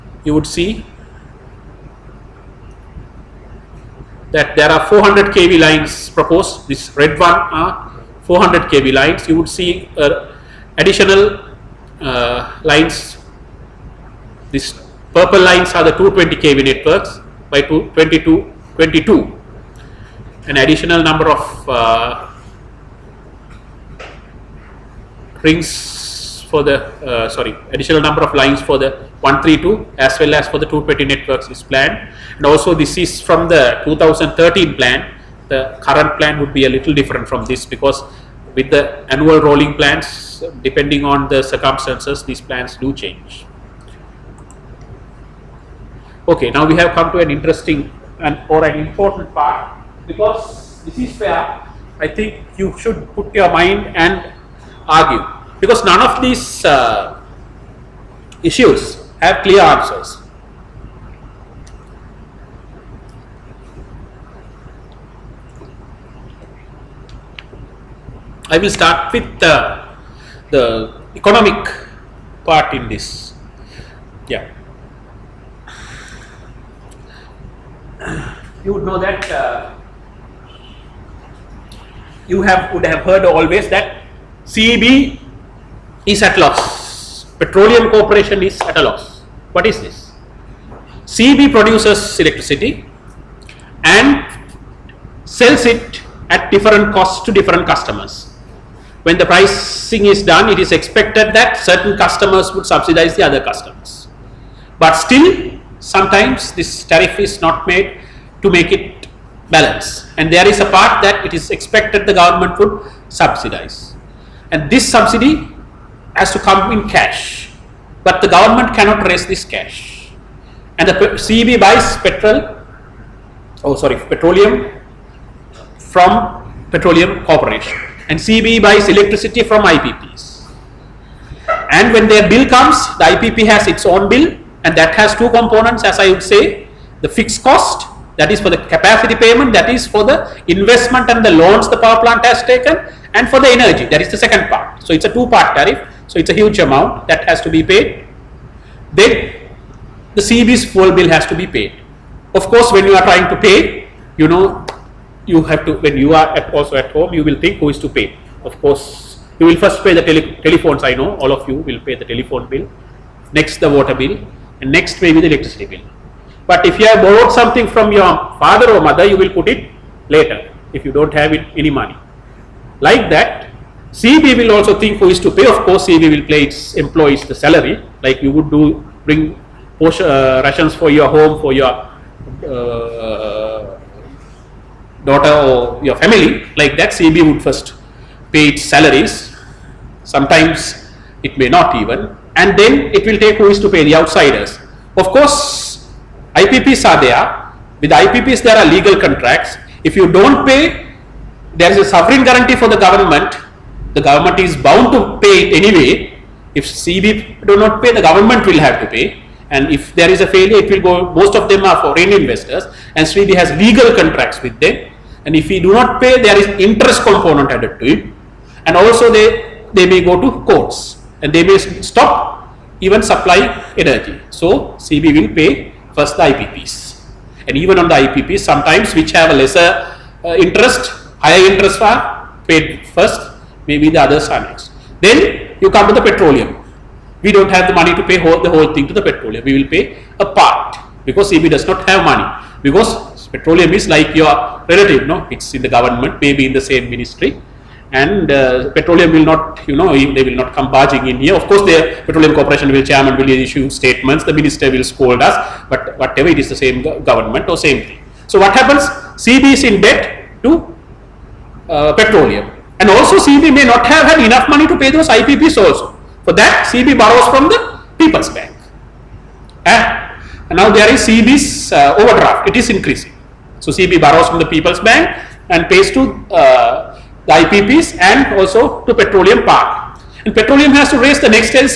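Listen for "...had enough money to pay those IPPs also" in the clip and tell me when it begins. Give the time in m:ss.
4:24.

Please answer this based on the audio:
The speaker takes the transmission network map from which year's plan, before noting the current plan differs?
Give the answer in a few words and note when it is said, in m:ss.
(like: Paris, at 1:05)
2013, at 0:33.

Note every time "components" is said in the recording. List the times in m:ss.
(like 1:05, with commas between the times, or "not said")
2:15, 3:37.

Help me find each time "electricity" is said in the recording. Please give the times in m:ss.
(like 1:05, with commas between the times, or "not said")
1:32, 2:08, 2:45.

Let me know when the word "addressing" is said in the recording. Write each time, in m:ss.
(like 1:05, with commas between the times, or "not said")
not said.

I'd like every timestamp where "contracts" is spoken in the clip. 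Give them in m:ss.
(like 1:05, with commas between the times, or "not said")
3:19, 3:33.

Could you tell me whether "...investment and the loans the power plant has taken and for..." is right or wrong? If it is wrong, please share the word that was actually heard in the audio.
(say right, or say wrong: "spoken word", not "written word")
right.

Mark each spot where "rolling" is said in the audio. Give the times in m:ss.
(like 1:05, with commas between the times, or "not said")
0:39.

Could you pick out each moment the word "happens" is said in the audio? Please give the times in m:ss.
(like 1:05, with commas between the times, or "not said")
4:18.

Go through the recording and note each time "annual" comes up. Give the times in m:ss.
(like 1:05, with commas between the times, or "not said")
0:39.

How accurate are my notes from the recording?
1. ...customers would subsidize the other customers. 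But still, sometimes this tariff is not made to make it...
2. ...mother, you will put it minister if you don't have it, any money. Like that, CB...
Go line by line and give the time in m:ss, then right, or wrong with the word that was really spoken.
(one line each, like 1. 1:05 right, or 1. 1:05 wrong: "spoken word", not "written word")
1. 1:41 right
2. 2:48 wrong: "later", not "minister".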